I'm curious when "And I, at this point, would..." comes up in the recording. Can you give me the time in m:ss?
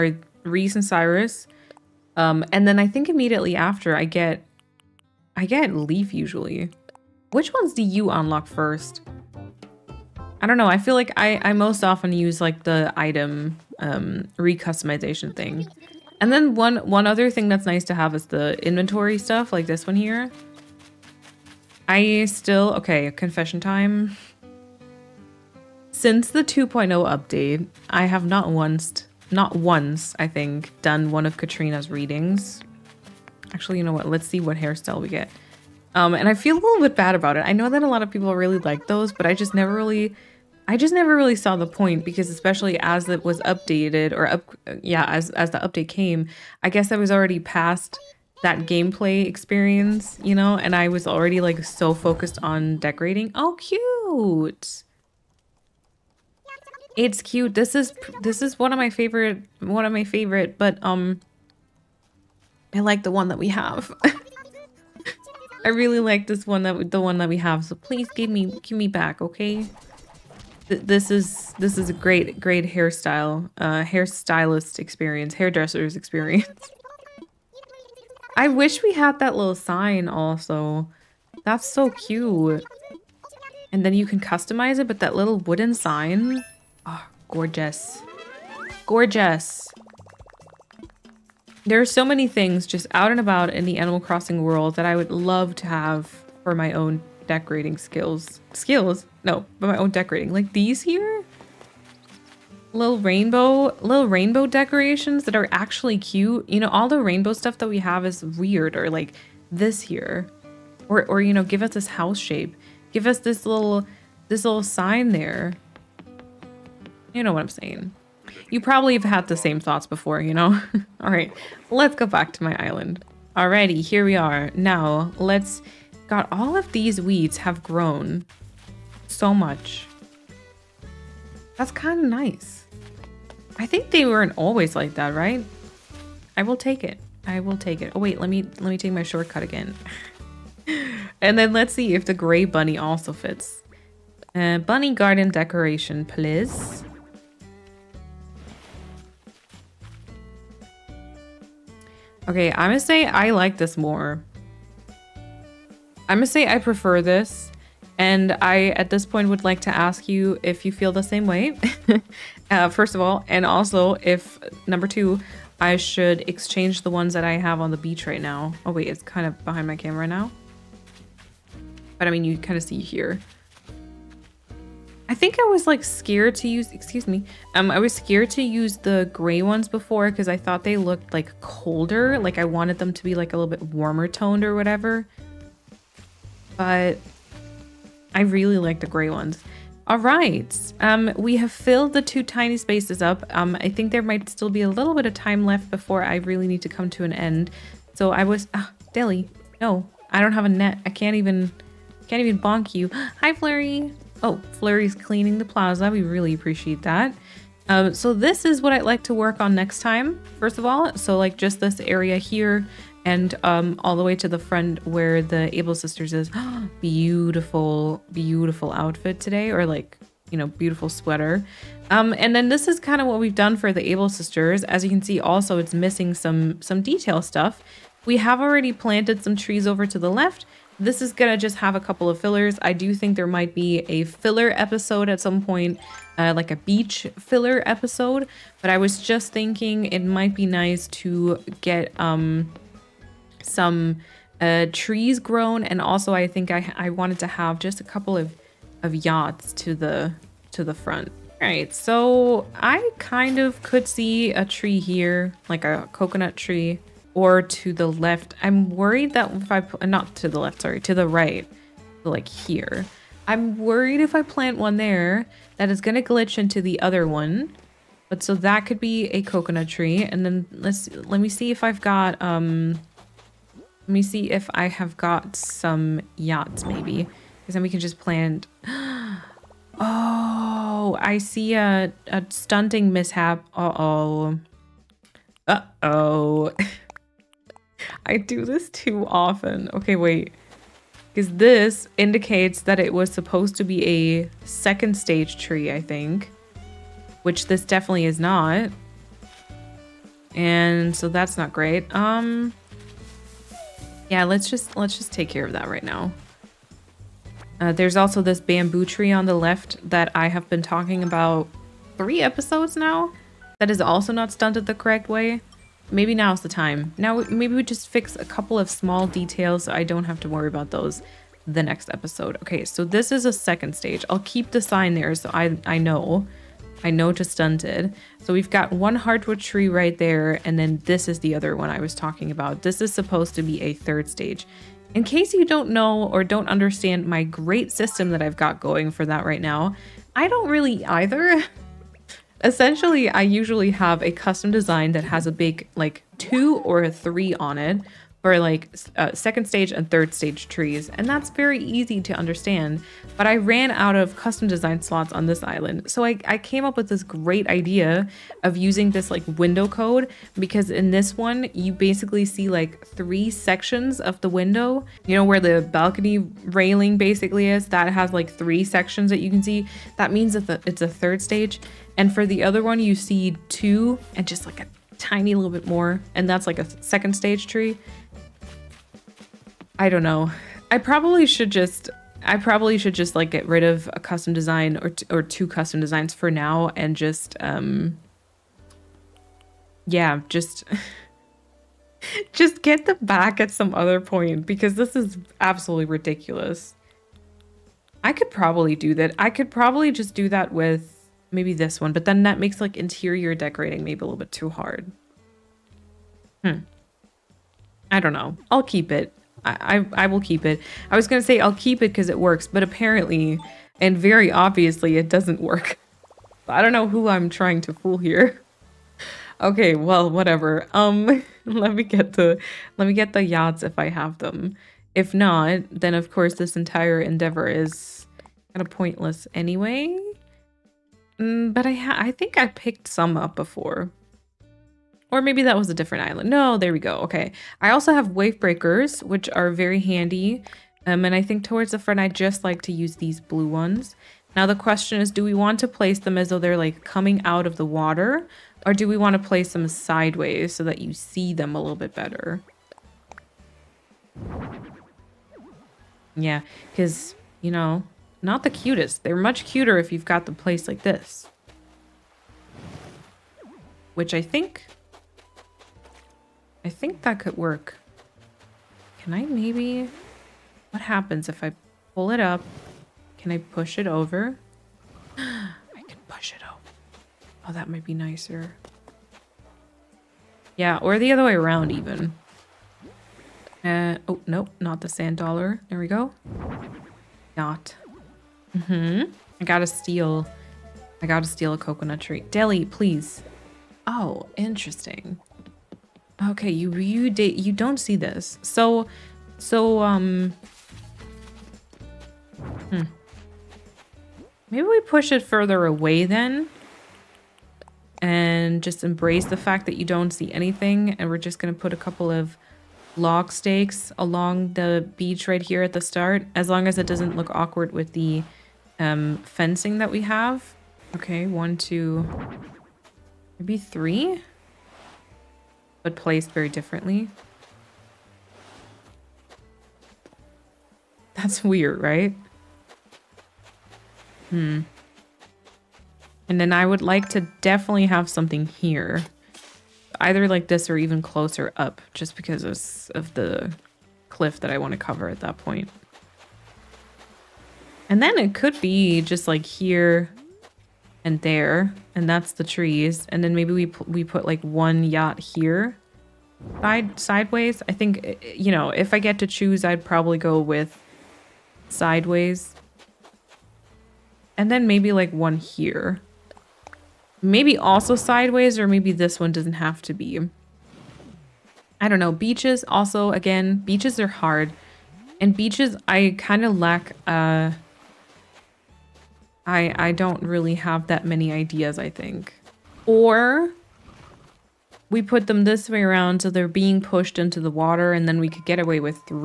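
2:37.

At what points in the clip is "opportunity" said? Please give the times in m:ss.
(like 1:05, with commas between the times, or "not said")
not said.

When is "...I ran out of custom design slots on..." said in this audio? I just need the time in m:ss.
5:53.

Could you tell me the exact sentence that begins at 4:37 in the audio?
Because then we can just plant.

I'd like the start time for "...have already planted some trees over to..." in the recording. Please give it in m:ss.
3:48.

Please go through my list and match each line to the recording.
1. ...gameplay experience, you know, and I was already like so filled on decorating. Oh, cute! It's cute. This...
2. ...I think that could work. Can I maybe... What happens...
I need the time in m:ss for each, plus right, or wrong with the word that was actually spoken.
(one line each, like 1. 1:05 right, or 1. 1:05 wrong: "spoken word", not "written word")
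1. 0:48 wrong: "focused", not "filled"
2. 7:46 right.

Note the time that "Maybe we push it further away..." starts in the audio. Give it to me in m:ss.
8:24.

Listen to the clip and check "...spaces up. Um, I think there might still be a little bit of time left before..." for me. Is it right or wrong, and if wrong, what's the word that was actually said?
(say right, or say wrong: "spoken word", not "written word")
right.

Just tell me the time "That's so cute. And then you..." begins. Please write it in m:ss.
1:21.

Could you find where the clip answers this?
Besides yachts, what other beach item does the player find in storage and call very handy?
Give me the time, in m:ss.
7:18.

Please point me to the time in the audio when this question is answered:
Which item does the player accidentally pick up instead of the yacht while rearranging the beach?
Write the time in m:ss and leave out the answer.
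8:04.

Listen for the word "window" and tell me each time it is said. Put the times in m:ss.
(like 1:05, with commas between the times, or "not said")
5:59, 6:04.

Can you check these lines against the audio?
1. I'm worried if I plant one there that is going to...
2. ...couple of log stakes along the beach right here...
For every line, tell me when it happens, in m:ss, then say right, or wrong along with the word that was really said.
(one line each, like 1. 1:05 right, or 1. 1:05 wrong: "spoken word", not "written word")
1. 4:23 right
2. 8:31 right.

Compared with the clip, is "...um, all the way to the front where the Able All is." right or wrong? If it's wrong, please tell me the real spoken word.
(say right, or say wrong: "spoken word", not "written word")
wrong: "Sisters", not "All".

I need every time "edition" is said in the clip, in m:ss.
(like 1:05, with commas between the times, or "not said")
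not said.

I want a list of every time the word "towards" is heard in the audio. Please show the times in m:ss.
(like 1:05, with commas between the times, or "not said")
7:21.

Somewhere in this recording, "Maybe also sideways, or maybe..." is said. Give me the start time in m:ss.
9:27.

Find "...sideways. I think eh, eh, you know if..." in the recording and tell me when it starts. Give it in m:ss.
9:16.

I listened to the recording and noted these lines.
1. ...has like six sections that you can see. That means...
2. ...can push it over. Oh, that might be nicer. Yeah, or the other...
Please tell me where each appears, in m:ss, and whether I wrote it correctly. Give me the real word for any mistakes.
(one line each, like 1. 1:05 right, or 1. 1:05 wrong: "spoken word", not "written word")
1. 6:07 wrong: "three", not "six"
2. 7:55 right.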